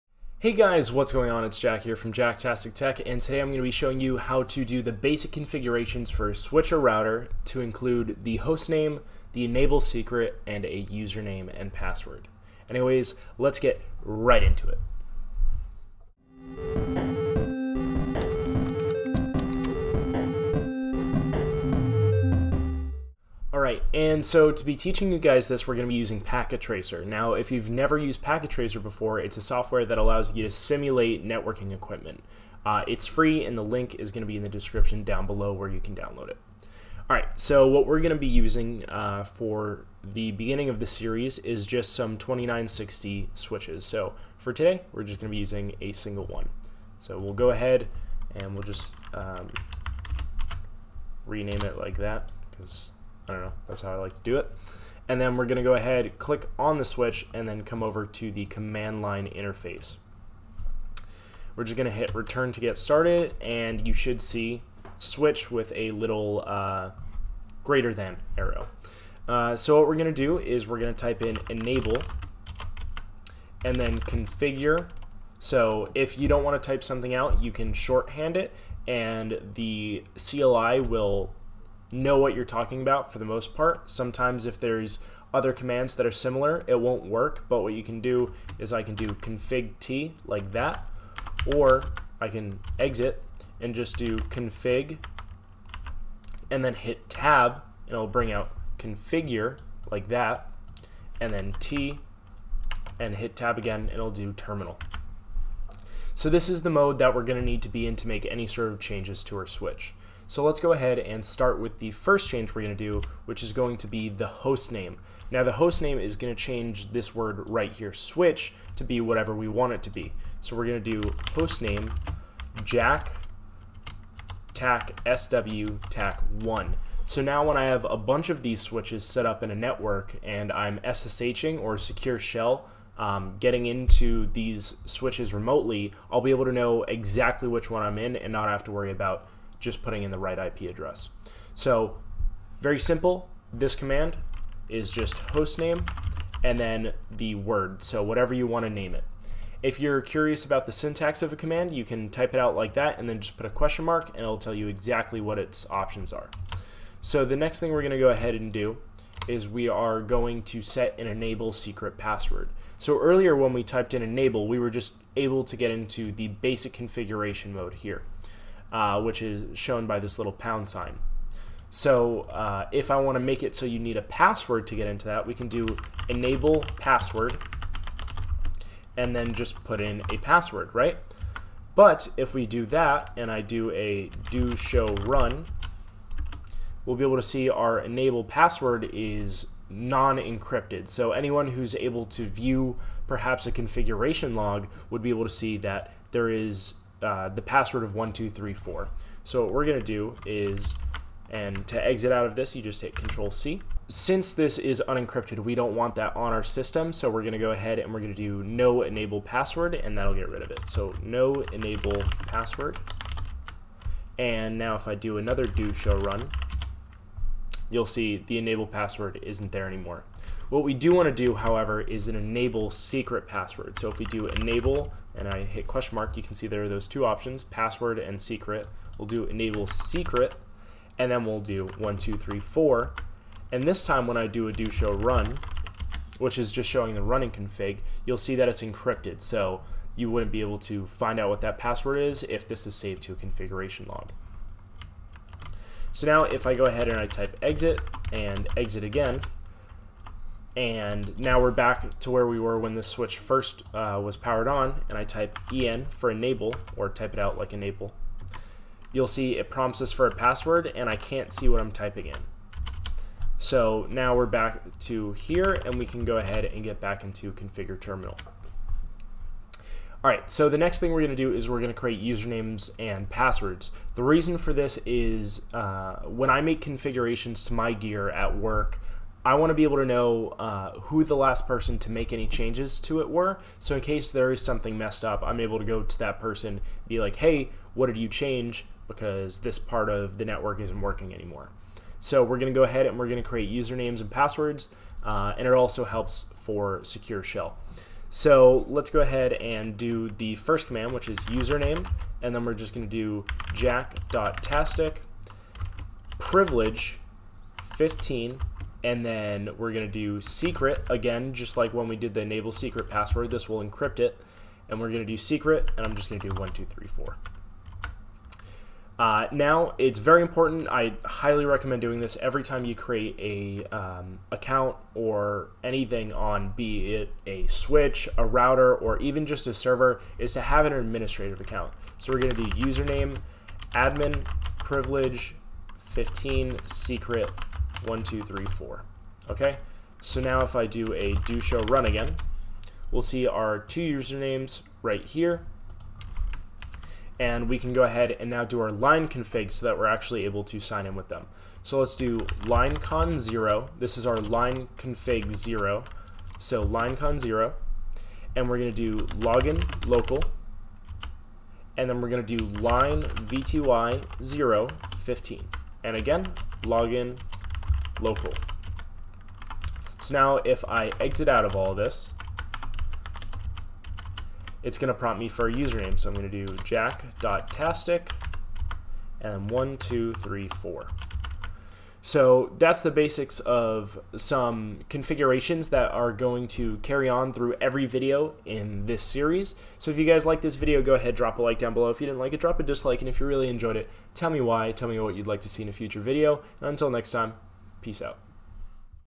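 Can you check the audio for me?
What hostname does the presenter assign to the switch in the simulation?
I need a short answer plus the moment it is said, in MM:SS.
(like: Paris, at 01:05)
jacktac-sw-tac1, at 02:02.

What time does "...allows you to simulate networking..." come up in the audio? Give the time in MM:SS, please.
00:29.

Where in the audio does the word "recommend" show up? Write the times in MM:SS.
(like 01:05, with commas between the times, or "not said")
05:21.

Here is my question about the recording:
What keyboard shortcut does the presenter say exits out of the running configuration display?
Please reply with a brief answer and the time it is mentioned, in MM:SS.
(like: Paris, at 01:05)
Control C, at 03:22.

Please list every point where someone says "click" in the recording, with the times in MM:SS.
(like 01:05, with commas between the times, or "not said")
00:56.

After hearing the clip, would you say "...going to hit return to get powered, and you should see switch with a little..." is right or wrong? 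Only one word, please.
wrong.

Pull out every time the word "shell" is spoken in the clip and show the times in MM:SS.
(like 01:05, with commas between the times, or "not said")
02:12, 04:57.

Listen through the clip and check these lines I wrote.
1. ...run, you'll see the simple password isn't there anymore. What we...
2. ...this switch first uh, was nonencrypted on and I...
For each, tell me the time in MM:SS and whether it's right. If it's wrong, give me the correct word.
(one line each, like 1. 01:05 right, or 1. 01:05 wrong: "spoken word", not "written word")
1. 03:35 wrong: "enable", not "simple"
2. 04:12 wrong: "powered", not "nonencrypted".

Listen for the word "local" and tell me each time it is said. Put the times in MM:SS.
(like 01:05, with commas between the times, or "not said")
05:59, 06:08.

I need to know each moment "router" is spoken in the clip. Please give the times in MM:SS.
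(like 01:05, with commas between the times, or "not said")
00:06, 05:28.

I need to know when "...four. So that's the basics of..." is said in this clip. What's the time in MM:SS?
06:20.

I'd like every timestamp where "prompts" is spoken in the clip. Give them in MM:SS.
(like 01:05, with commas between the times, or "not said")
04:19, 06:14.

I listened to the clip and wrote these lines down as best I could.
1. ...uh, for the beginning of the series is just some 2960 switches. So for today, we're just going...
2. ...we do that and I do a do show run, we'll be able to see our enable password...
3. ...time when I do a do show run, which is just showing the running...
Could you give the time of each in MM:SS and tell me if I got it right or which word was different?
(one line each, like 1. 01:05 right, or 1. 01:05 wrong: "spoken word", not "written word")
1. 00:38 right
2. 03:02 right
3. 03:53 right.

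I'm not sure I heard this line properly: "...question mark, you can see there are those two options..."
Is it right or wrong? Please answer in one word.
right.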